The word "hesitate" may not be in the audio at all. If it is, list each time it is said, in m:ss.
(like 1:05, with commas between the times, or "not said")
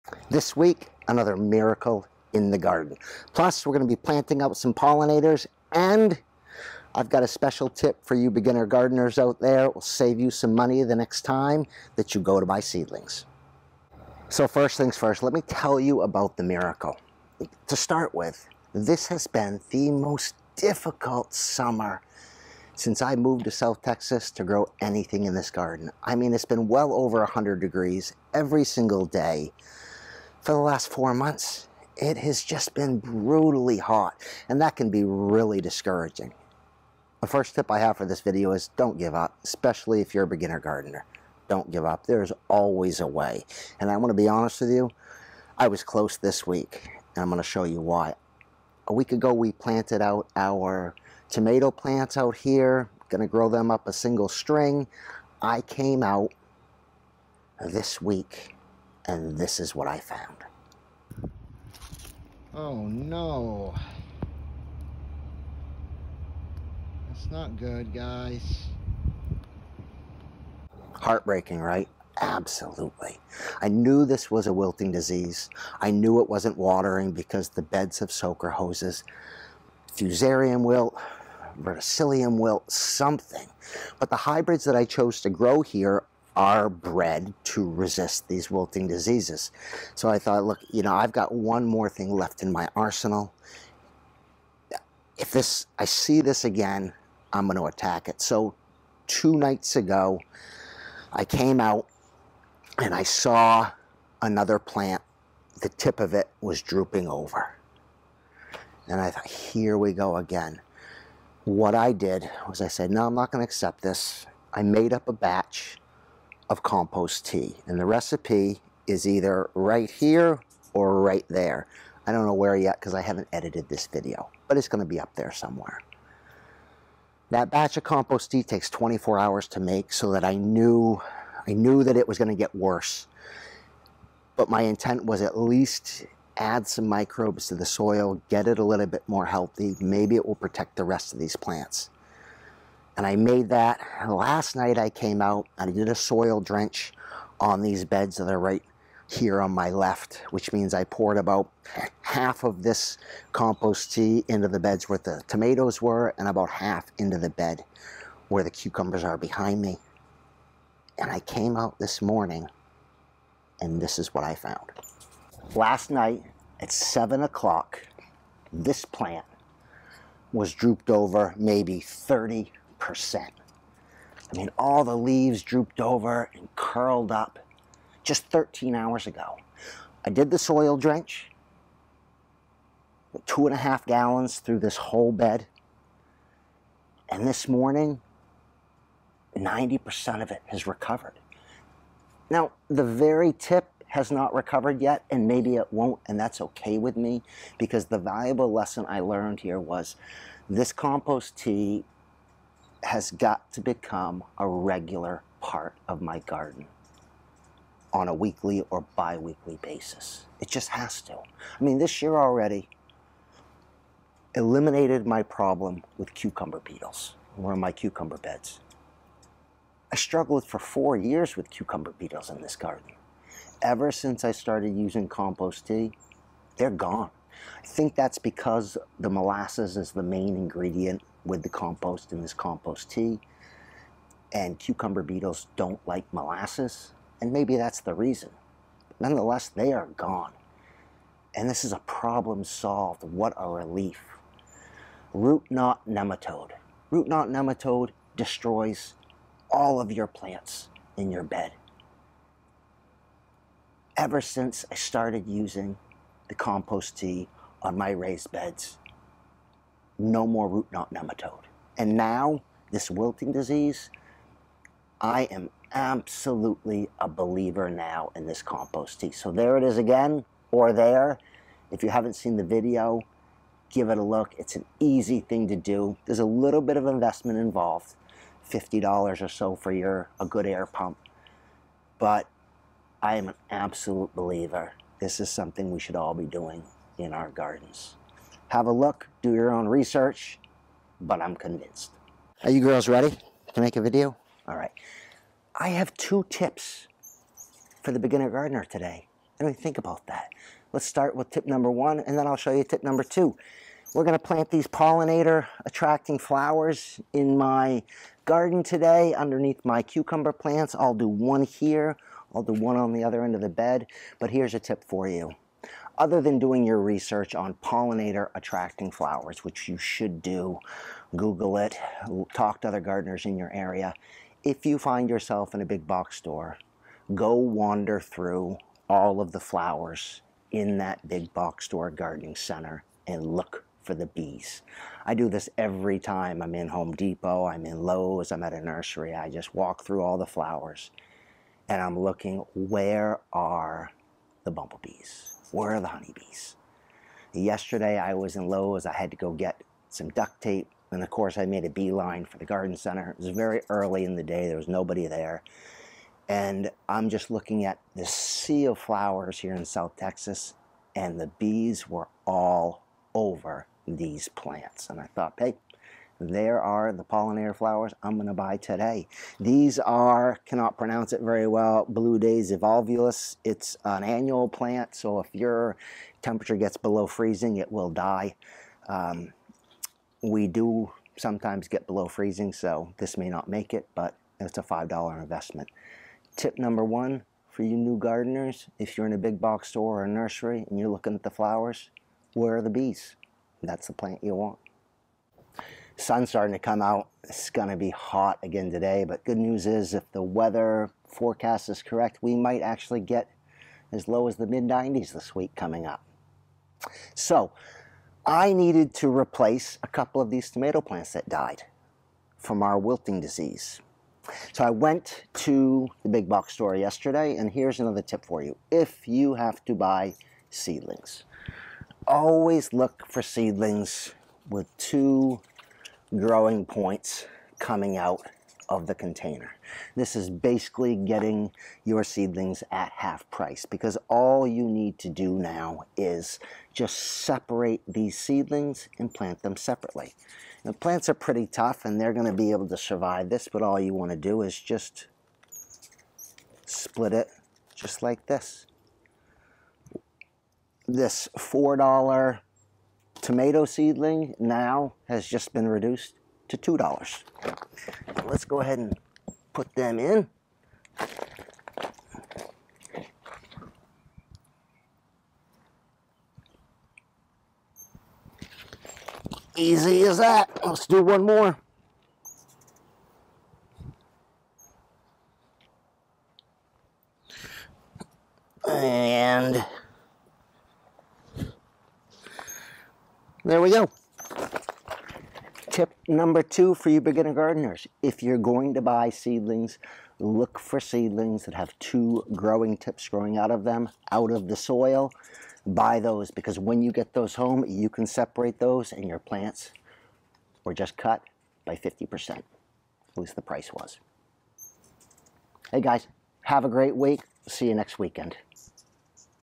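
not said.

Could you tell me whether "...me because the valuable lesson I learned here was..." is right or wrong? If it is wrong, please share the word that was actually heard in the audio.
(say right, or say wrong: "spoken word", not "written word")
right.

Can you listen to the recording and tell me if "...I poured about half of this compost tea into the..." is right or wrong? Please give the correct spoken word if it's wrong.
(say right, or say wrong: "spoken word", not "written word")
right.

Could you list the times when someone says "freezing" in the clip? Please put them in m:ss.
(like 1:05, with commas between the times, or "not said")
6:17, 6:22.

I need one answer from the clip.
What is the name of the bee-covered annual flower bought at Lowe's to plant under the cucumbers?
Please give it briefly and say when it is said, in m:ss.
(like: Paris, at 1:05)
Blue Daze evolvulus, at 6:11.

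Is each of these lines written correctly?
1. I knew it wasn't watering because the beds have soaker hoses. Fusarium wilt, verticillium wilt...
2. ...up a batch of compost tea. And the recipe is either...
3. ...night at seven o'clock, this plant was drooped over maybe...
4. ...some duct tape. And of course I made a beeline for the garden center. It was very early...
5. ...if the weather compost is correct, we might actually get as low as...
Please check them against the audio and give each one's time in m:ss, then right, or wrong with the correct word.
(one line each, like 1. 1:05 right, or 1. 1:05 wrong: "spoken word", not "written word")
1. 1:15 right
2. 1:54 right
3. 2:45 right
4. 5:49 right
5. 6:39 wrong: "forecast", not "compost".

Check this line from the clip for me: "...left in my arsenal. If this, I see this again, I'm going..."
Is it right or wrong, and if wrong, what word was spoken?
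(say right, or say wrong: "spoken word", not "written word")
right.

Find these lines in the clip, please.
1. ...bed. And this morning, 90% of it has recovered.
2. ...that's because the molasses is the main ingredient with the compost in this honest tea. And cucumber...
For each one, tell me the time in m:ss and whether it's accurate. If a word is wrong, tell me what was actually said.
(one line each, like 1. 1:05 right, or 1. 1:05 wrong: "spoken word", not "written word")
1. 3:05 right
2. 3:47 wrong: "compost", not "honest".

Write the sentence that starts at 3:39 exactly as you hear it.
I struggled for four years with cucumber beetles in this garden.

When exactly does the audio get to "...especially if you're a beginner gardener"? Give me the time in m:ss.
0:39.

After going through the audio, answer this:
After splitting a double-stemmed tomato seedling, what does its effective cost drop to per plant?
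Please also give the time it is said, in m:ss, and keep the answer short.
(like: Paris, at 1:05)
$2, at 7:36.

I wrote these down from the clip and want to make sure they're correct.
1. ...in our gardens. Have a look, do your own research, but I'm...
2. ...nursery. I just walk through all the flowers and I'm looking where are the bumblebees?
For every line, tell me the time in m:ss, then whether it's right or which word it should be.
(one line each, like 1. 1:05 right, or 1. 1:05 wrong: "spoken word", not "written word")
1. 4:46 right
2. 5:38 right.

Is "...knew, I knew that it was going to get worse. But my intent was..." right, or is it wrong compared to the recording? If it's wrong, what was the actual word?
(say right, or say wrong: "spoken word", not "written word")
right.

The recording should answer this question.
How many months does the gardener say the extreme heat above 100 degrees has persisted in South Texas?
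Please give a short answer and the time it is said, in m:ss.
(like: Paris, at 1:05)
4, at 0:30.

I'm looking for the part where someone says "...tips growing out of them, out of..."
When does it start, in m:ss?
8:12.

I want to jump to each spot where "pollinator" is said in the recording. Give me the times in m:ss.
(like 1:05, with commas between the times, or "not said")
0:04, 5:04, 5:17, 6:07.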